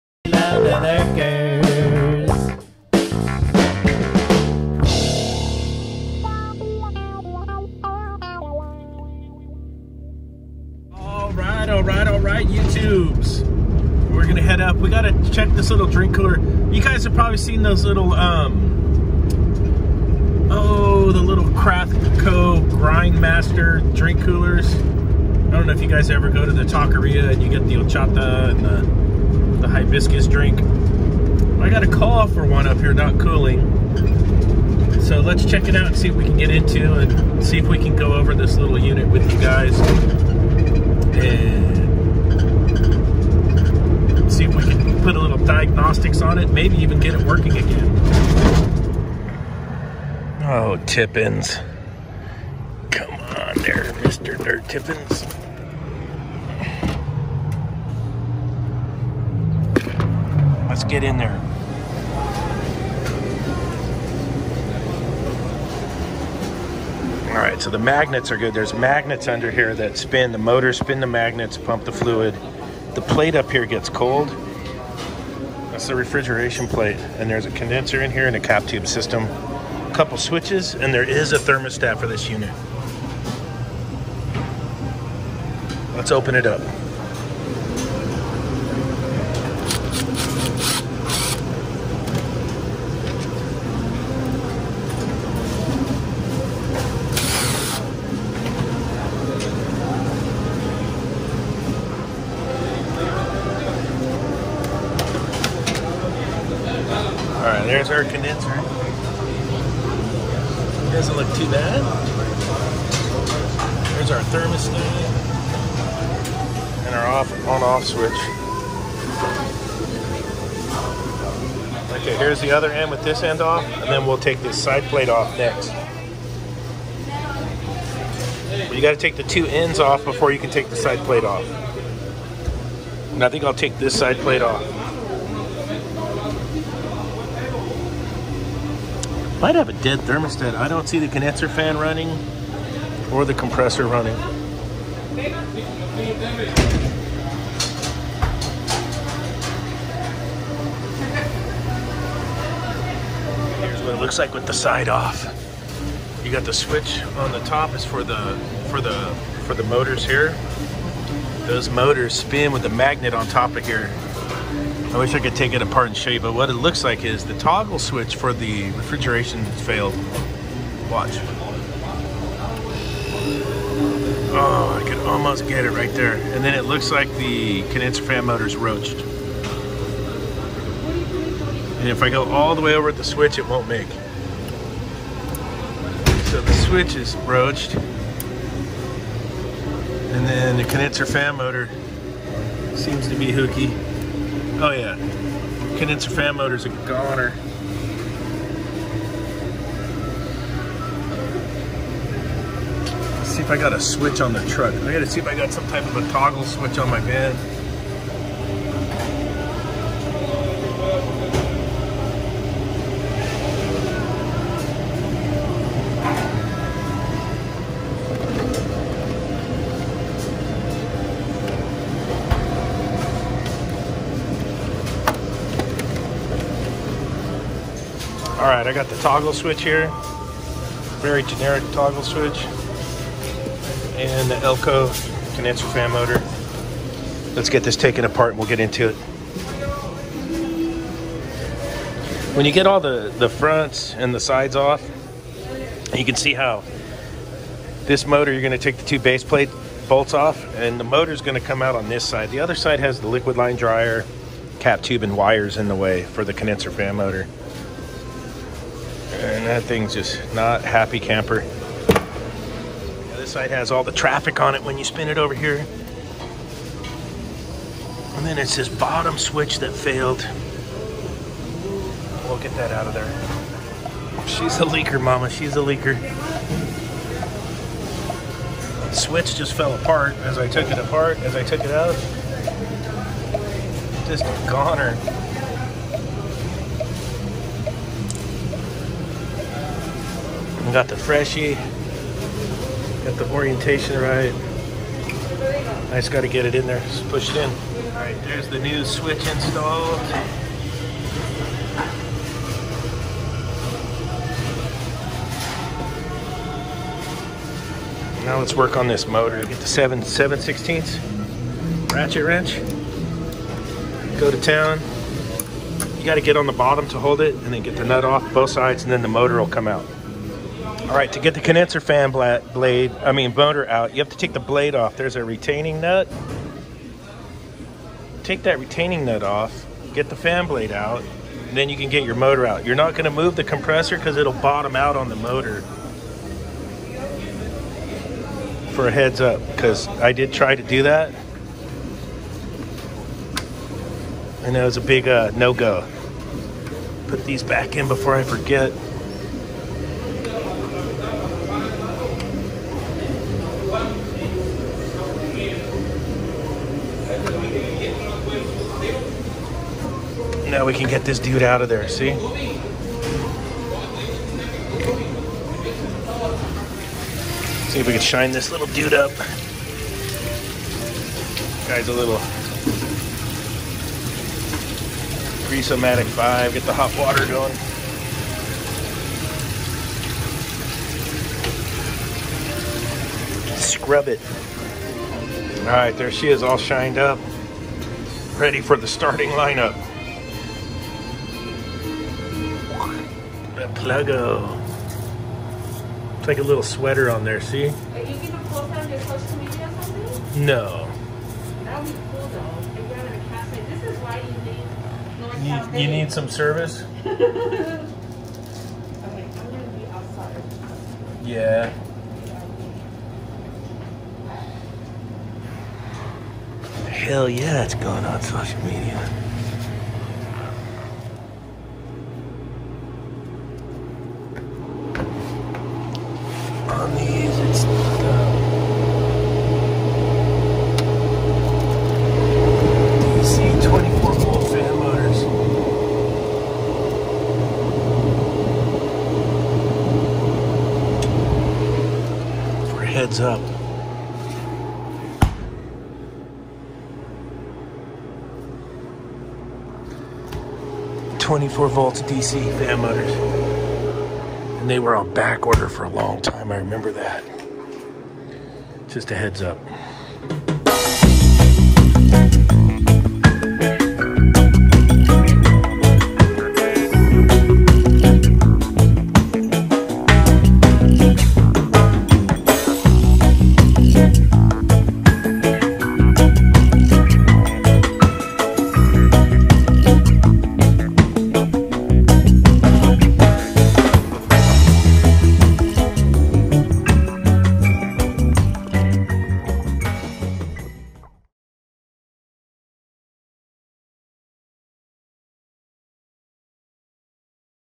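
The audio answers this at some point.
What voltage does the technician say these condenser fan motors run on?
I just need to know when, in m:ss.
7:31.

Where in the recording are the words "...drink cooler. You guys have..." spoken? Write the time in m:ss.
0:15.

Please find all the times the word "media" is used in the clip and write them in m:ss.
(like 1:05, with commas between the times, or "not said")
6:39, 6:58.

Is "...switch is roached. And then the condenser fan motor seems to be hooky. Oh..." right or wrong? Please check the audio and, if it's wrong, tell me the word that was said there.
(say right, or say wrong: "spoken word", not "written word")
right.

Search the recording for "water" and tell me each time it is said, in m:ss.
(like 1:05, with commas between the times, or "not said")
6:16.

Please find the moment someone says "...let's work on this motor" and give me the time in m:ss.
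5:08.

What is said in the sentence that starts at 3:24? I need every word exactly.
I gotta see if I got some type of a toggle switch on my van.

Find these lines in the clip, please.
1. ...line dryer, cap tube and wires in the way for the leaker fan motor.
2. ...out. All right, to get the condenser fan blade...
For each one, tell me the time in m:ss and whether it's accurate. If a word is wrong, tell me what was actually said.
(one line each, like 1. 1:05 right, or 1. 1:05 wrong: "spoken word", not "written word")
1. 4:13 wrong: "condenser", not "leaker"
2. 5:19 right.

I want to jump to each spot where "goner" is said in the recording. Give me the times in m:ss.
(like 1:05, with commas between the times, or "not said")
3:16, 4:44.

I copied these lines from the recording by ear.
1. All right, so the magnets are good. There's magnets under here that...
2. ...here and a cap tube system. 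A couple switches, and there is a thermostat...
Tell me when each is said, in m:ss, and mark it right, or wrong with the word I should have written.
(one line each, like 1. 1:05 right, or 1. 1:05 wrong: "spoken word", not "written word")
1. 1:07 right
2. 1:18 right.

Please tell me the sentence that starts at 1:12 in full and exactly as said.
The plate up here gets cold.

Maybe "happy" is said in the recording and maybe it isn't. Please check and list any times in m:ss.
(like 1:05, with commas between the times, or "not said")
4:20.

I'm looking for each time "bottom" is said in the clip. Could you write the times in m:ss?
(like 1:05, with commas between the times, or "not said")
4:28, 5:16, 5:34.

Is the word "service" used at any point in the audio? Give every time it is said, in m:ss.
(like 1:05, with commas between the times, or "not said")
6:46.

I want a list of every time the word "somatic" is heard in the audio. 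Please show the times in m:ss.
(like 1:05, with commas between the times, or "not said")
6:15.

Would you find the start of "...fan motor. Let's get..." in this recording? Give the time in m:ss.
3:55.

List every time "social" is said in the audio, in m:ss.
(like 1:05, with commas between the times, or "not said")
6:39, 6:58.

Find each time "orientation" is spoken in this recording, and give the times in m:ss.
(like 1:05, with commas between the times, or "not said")
4:53.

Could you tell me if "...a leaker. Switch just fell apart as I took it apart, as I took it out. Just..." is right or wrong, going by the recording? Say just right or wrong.
right.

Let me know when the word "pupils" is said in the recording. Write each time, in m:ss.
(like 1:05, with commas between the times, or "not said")
not said.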